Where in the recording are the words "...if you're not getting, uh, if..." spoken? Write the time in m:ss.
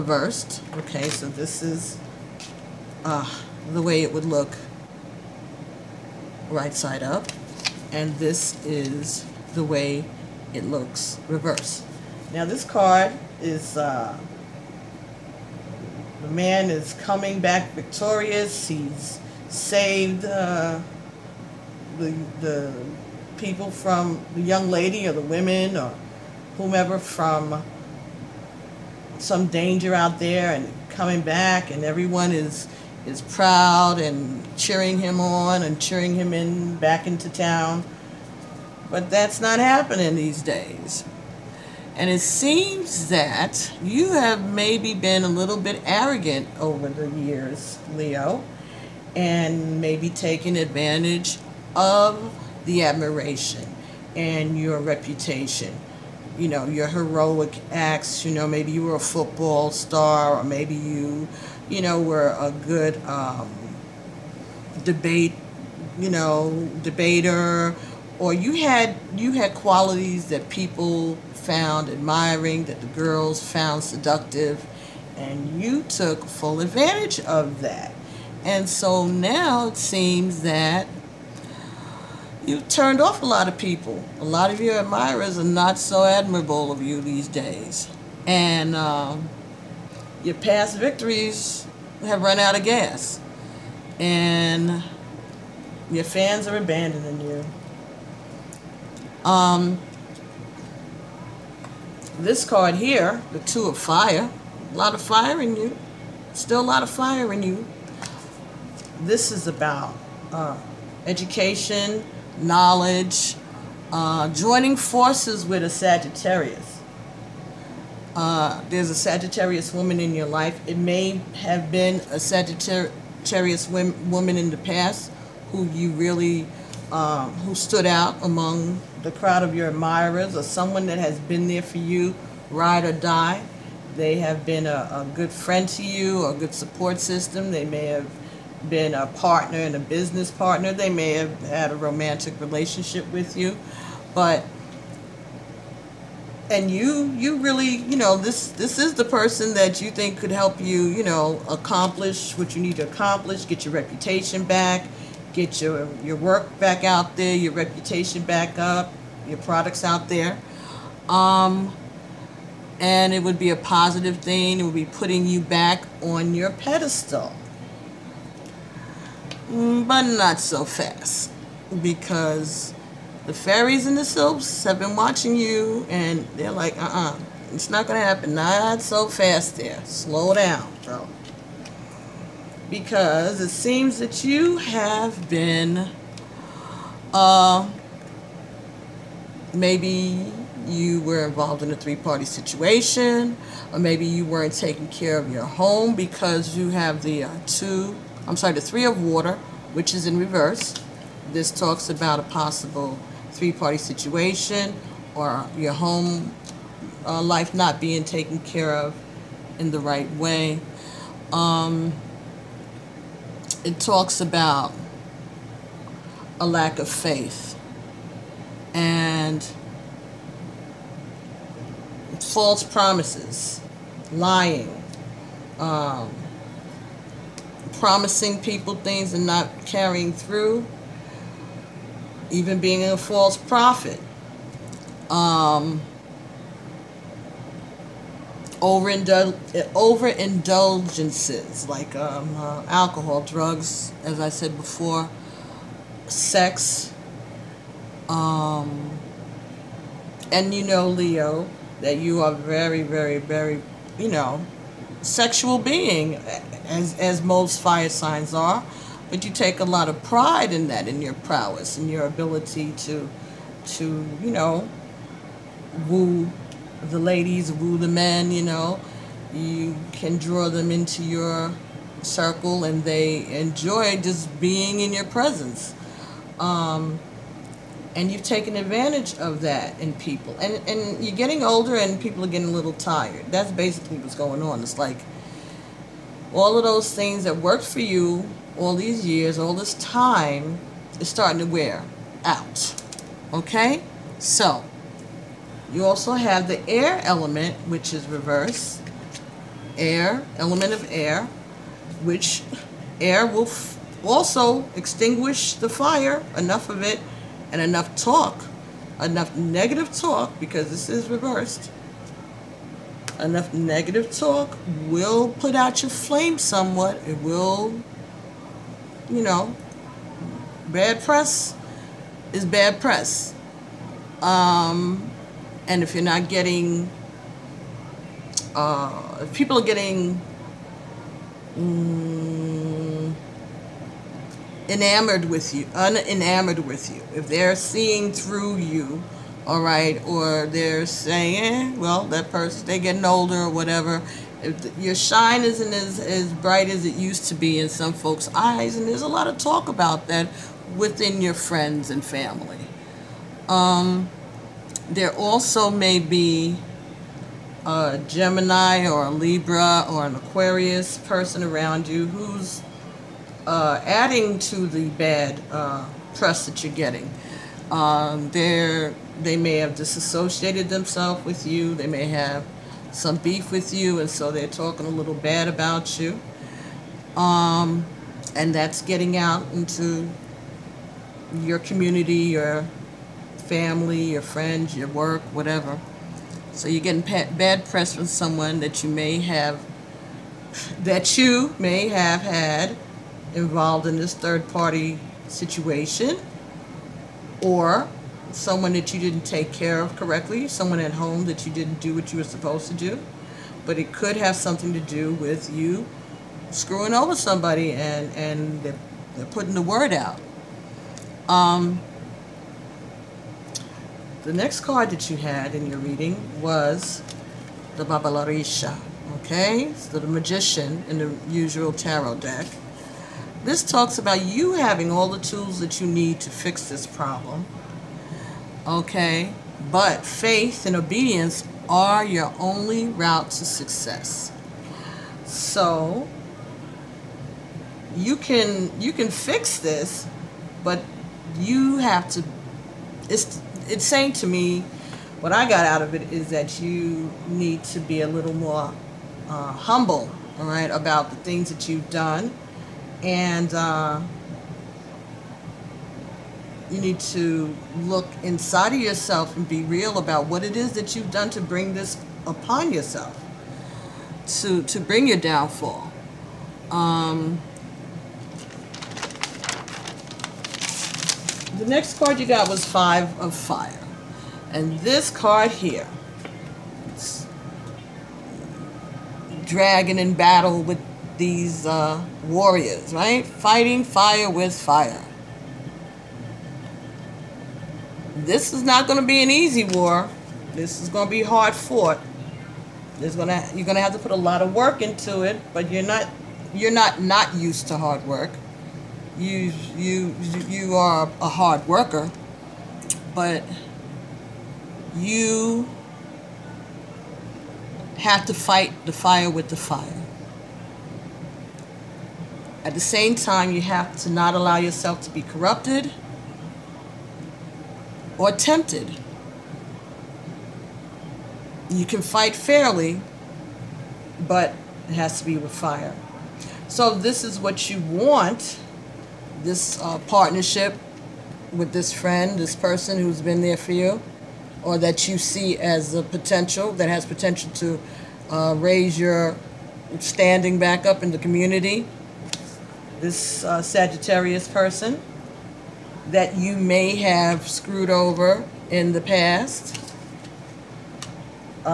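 5:25.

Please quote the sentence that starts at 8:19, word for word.
You you you are a hard worker, but you have to fight the fire with the fire.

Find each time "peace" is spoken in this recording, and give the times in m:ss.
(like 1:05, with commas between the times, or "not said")
not said.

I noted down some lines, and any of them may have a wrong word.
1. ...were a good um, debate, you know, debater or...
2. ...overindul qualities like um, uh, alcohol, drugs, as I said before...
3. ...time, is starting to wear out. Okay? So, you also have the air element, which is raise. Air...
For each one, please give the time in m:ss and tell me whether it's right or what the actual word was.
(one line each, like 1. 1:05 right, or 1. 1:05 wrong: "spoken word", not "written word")
1. 1:02 right
2. 3:58 wrong: "overindulgences", not "qualities"
3. 4:49 wrong: "reverse", not "raise".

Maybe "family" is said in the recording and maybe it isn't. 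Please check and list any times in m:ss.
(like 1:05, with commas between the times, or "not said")
5:52, 6:23.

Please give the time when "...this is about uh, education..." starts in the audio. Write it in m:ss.
1:49.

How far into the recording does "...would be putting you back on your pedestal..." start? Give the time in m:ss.
2:44.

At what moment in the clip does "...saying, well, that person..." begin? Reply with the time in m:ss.
5:40.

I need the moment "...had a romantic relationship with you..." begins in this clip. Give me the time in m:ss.
2:21.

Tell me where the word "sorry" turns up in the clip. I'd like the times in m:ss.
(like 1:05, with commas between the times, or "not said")
3:18.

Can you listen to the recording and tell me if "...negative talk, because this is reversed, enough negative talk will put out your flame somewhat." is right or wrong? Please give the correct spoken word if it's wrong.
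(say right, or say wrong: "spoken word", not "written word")
right.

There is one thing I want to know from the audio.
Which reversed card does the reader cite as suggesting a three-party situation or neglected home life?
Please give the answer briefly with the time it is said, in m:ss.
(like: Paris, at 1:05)
Three of Water, at 3:18.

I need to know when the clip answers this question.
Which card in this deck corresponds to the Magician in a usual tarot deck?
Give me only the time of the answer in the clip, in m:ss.
6:57.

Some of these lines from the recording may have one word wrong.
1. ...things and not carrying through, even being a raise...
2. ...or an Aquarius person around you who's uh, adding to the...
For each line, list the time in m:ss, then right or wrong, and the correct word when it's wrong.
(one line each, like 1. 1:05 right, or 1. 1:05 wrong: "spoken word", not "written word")
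1. 3:48 wrong: "false", not "raise"
2. 5:59 right.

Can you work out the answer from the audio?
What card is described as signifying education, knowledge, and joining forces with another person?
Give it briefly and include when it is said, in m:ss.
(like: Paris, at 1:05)
Two of Fire, at 1:43.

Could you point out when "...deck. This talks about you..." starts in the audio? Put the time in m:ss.
7:02.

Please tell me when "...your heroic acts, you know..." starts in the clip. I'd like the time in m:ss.
0:56.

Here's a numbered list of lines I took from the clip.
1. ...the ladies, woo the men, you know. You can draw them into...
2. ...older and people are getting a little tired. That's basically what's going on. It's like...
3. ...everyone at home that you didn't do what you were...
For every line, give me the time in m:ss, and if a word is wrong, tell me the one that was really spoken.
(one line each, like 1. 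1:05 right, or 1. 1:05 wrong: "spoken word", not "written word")
1. 4:26 right
2. 4:41 right
3. 6:40 wrong: "someone", not "everyone".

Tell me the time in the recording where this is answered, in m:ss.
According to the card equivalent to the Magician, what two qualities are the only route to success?
7:10.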